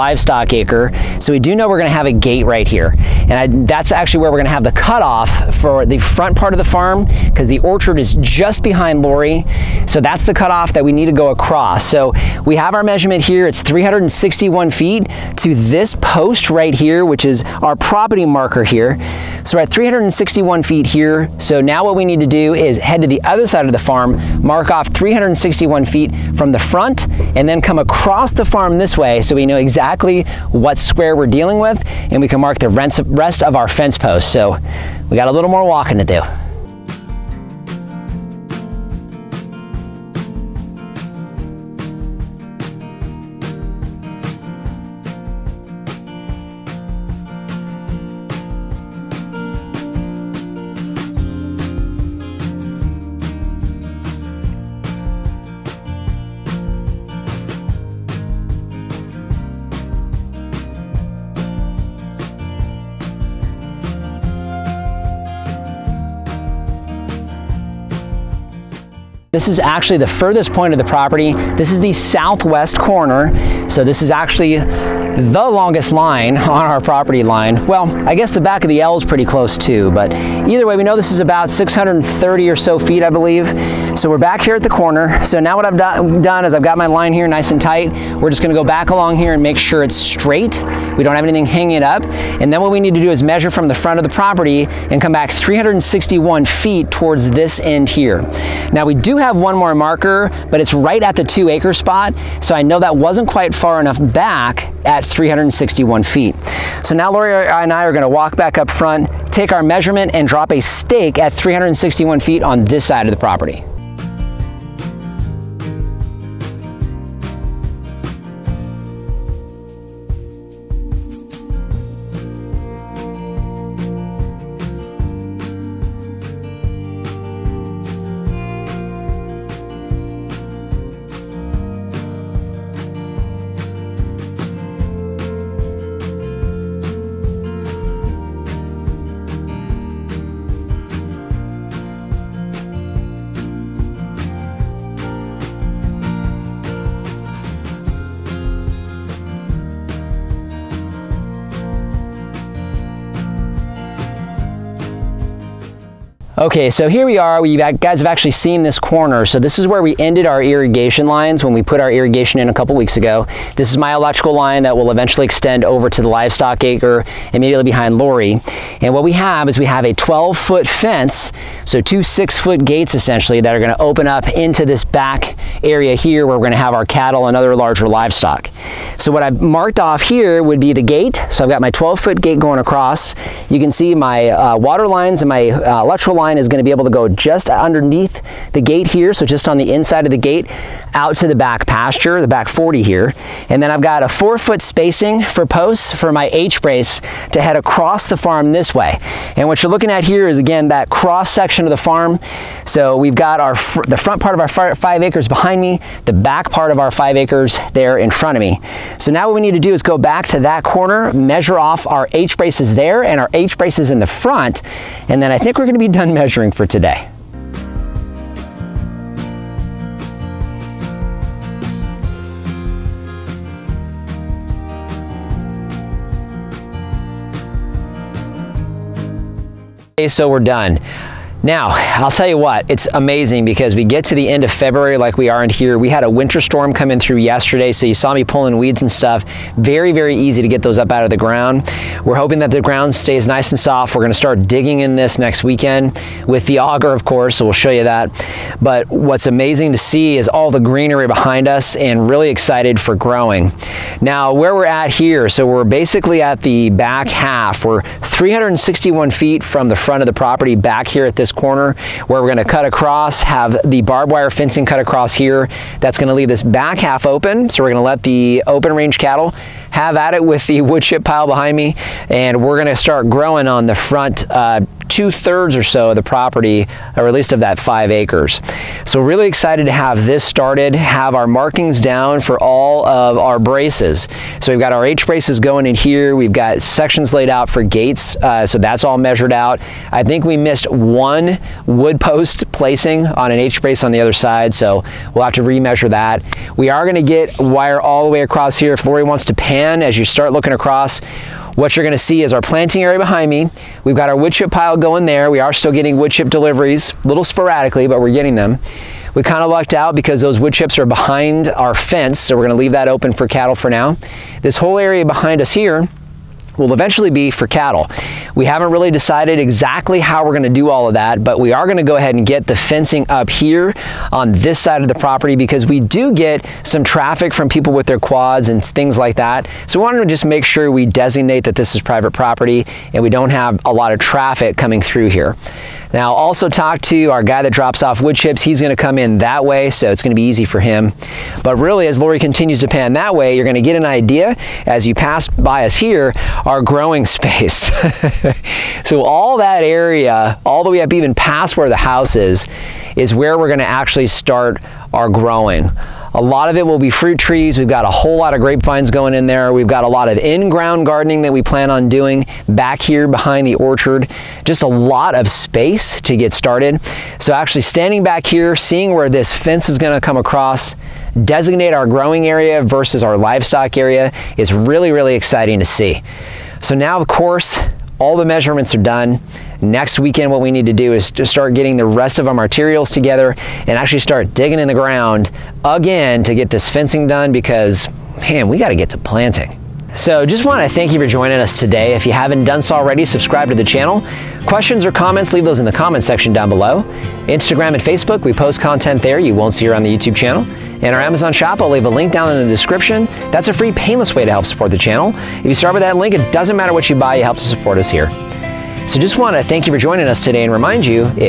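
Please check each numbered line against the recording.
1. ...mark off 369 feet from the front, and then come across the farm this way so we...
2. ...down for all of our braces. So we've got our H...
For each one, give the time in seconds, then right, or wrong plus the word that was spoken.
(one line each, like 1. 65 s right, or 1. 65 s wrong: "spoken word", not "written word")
1. 24 s wrong: "361", not "369"
2. 281 s right.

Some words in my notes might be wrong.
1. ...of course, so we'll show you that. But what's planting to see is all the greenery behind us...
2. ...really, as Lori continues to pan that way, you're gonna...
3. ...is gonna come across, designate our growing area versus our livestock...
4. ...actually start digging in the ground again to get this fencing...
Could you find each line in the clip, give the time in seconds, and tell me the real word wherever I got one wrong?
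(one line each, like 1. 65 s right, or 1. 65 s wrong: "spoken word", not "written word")
1. 246 s wrong: "amazing", not "planting"
2. 341 s right
3. 369 s right
4. 383 s right.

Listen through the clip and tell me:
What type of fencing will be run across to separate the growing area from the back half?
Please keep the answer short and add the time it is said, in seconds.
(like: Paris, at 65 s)
barbed wire, at 263 s.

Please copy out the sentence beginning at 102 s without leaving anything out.
So I know that wasn't quite far enough back at 361 feet.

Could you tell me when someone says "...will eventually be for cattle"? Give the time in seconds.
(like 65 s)
316 s.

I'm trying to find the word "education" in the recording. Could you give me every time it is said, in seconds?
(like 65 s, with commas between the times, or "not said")
not said.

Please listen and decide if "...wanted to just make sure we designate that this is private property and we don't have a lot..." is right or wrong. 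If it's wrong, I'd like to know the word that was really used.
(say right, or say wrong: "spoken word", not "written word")
right.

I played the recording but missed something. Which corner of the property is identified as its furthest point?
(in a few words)
southwest corner.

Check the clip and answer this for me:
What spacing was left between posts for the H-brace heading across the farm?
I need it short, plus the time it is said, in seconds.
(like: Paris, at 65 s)
4 feet, at 194 s.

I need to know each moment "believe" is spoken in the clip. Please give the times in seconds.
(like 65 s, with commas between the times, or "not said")
83 s.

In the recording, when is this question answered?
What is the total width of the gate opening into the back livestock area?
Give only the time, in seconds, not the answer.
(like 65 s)
169 s.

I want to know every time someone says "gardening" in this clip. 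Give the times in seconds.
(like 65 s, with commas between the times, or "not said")
360 s.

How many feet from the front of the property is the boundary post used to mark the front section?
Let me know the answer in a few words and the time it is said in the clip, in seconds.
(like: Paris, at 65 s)
361 feet, at 13 s.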